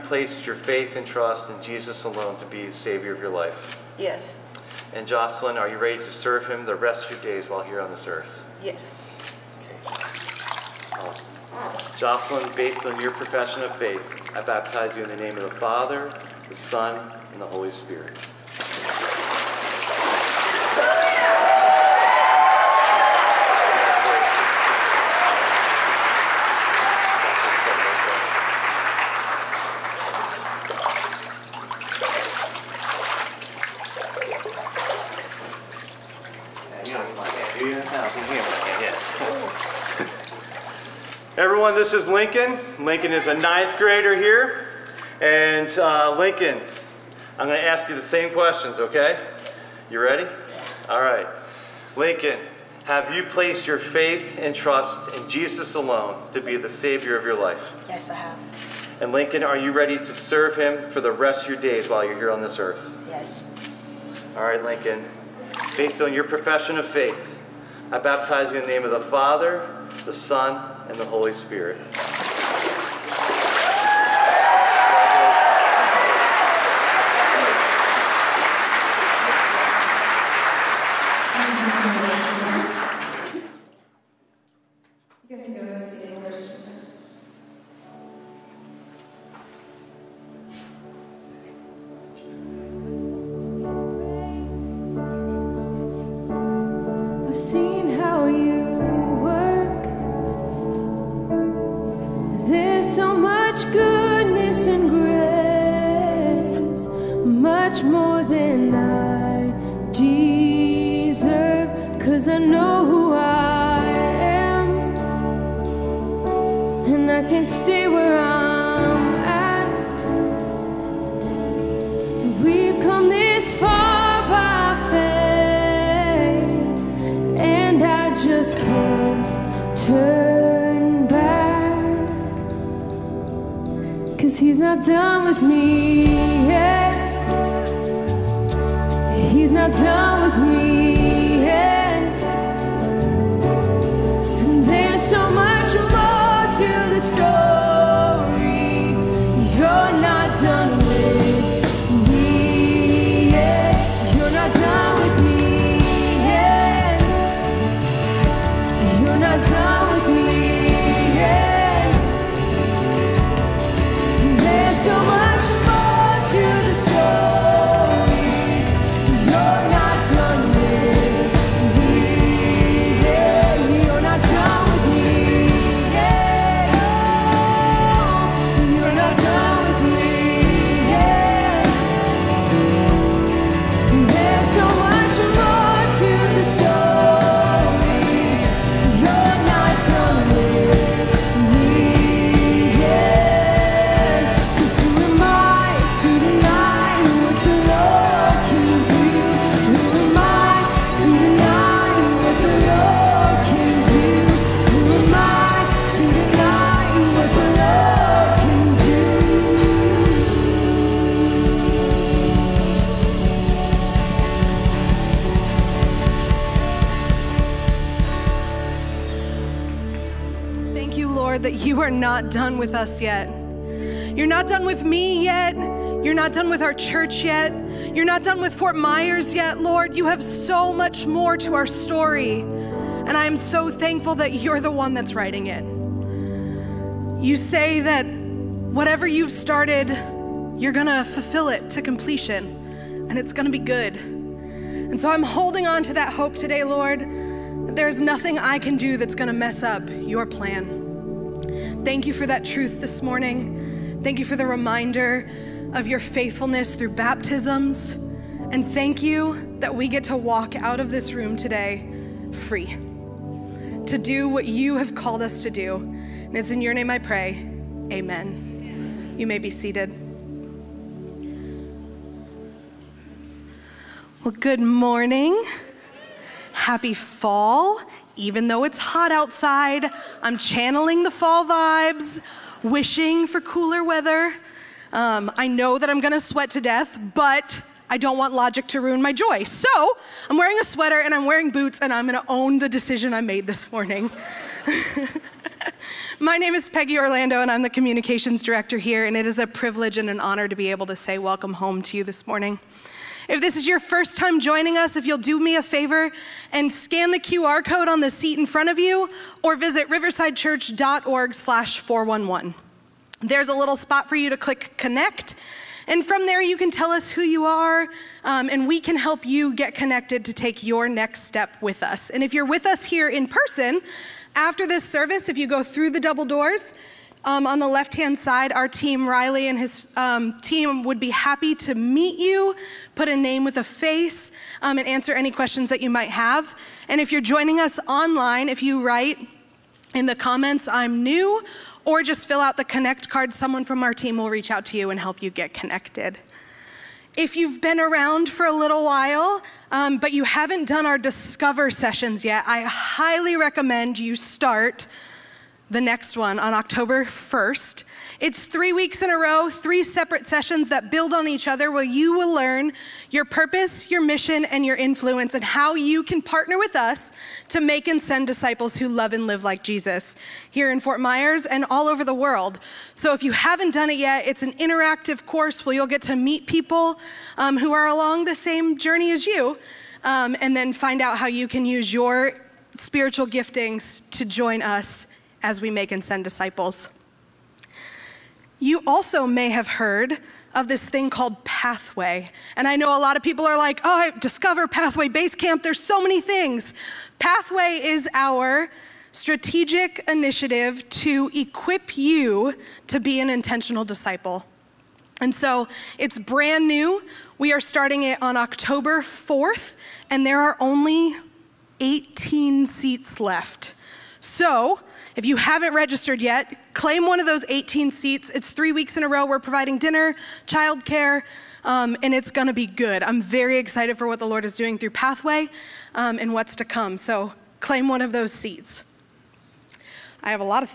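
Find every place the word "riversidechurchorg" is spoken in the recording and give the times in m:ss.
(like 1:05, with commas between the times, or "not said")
5:09.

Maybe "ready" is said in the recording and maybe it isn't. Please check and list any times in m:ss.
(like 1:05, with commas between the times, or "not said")
0:05, 0:49, 0:59.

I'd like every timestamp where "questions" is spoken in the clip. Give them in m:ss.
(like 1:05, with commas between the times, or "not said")
0:48, 5:35.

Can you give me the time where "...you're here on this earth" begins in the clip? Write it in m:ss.
1:02.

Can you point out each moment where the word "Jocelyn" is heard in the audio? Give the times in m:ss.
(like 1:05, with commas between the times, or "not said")
0:05, 0:11.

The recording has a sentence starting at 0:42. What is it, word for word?
Lincoln is a ninth grader here.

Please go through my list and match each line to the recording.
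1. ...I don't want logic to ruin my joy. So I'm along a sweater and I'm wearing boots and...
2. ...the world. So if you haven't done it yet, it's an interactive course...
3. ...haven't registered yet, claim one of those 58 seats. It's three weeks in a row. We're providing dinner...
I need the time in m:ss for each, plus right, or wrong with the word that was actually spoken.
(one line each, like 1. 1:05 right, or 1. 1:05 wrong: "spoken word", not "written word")
1. 4:47 wrong: "wearing", not "along"
2. 6:12 right
3. 6:55 wrong: "18", not "58".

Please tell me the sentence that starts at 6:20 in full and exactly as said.
Um, and then find out how you can use your spiritual giftings to join us as we make and send disciples.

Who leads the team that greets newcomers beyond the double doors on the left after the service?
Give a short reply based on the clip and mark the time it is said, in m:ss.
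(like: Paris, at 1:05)
Riley, at 5:29.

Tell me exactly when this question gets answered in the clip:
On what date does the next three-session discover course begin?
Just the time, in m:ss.
5:56.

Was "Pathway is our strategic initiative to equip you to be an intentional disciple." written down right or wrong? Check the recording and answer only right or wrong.
right.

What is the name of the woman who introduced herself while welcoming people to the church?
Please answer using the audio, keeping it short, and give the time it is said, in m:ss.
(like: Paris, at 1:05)
Peggy Orlando, at 4:56.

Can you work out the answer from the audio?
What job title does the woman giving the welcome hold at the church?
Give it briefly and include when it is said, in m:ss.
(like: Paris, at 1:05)
Communications director, at 4:57.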